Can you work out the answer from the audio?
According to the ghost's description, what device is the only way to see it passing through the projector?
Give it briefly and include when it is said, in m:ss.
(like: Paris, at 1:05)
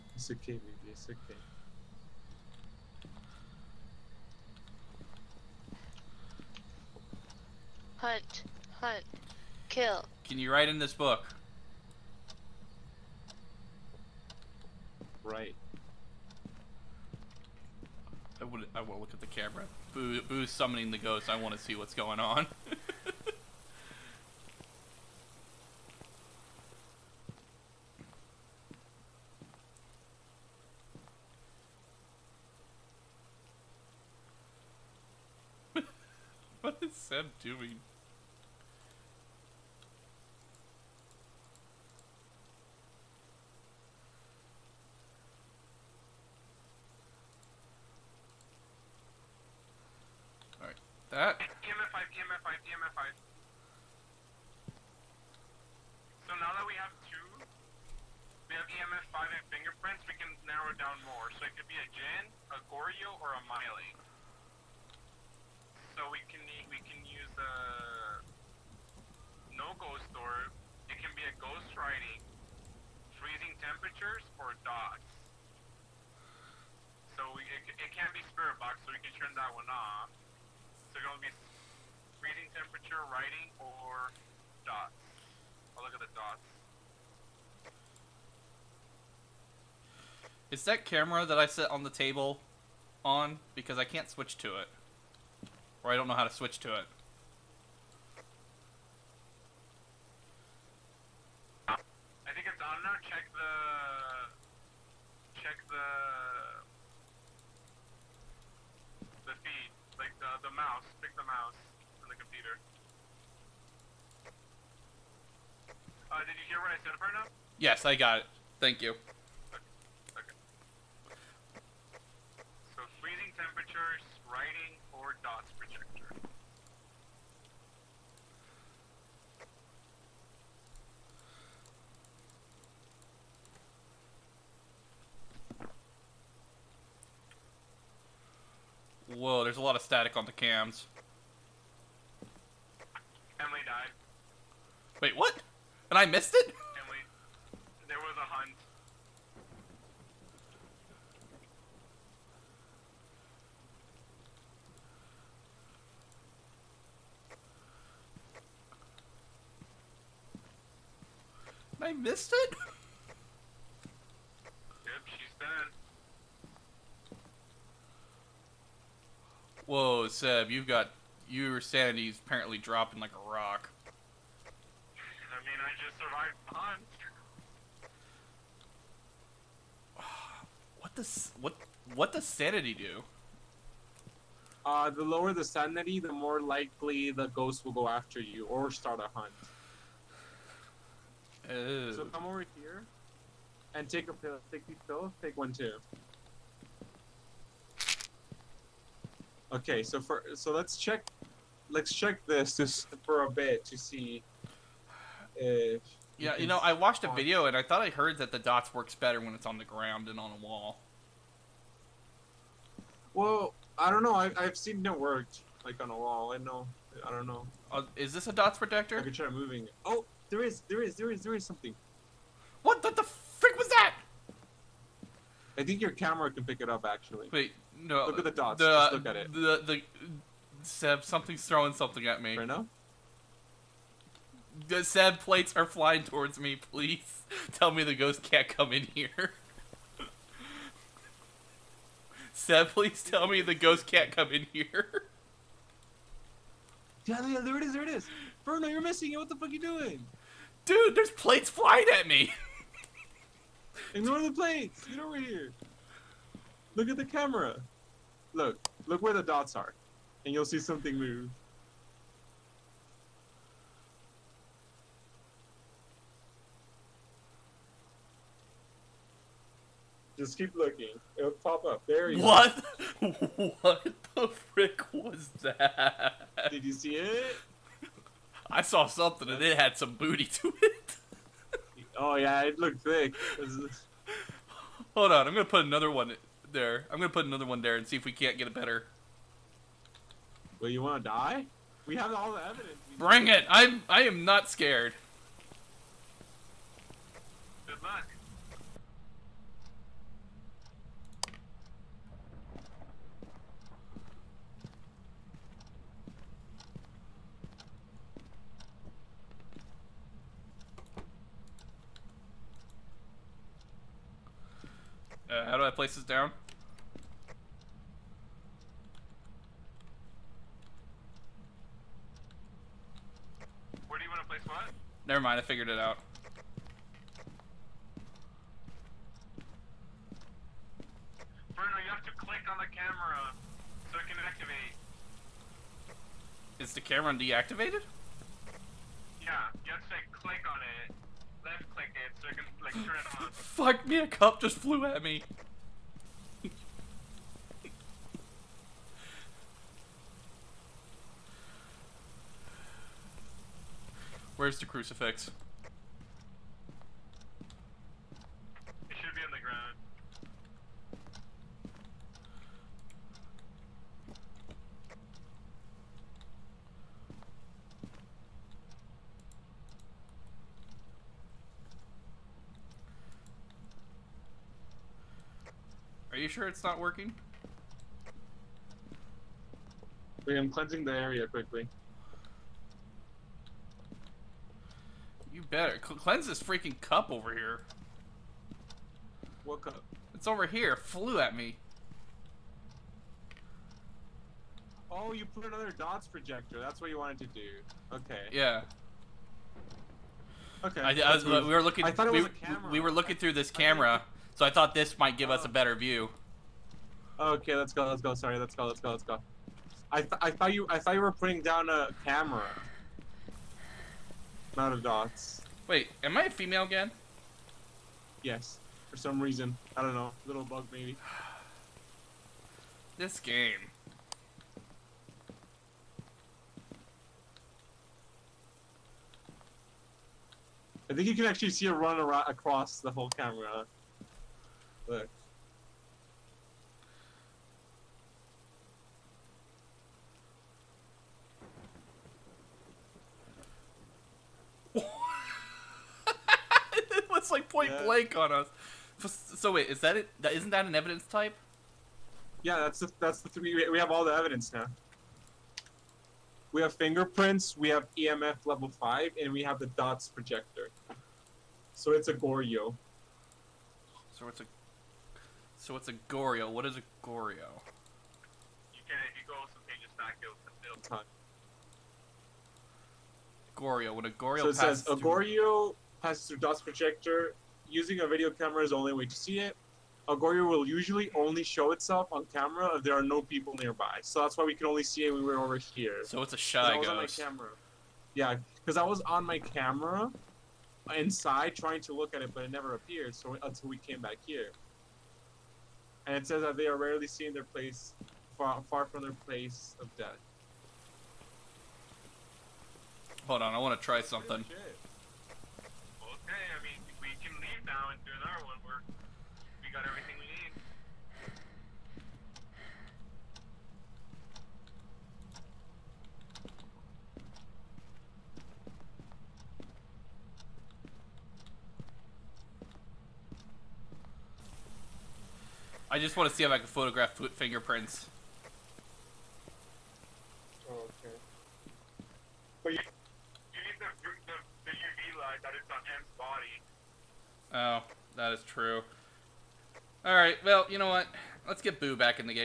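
A video camera, at 7:58.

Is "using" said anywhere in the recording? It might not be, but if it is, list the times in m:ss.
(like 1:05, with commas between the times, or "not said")
7:57.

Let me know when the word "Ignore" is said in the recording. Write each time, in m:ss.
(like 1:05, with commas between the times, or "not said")
4:13.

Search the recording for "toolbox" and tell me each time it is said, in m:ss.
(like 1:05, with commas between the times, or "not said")
not said.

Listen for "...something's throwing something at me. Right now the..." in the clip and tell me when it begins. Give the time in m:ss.
3:51.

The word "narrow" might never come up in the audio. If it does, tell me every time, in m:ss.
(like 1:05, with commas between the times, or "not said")
1:00.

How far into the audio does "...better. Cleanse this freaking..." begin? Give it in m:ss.
6:25.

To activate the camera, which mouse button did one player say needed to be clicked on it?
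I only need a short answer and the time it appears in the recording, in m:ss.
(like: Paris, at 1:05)
Left click, at 5:41.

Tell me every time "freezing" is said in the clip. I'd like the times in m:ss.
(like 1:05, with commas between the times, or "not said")
1:13, 2:03.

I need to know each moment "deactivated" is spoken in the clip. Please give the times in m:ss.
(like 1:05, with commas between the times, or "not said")
5:37.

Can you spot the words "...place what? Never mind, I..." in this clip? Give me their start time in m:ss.
5:24.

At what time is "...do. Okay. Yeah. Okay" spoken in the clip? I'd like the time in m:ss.
6:37.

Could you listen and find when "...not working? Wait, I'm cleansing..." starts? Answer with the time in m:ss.
6:16.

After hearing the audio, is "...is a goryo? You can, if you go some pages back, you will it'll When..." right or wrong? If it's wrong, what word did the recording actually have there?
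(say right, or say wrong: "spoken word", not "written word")
right.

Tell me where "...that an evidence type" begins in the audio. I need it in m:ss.
7:30.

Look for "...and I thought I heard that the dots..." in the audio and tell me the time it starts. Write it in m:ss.
3:27.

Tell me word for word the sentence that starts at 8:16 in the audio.
And it says that they are rarely seen their place far, far from their place of death.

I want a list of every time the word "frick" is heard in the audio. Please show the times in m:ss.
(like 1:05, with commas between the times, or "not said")
3:43, 4:34.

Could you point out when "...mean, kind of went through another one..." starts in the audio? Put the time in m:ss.
8:26.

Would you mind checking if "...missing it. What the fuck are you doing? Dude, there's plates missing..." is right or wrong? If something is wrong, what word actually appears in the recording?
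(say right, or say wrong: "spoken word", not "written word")
wrong: "flying", not "missing".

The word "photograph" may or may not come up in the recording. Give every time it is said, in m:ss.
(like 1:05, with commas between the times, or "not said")
8:46.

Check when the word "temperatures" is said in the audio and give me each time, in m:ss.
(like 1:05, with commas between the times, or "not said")
1:13, 1:22, 2:03.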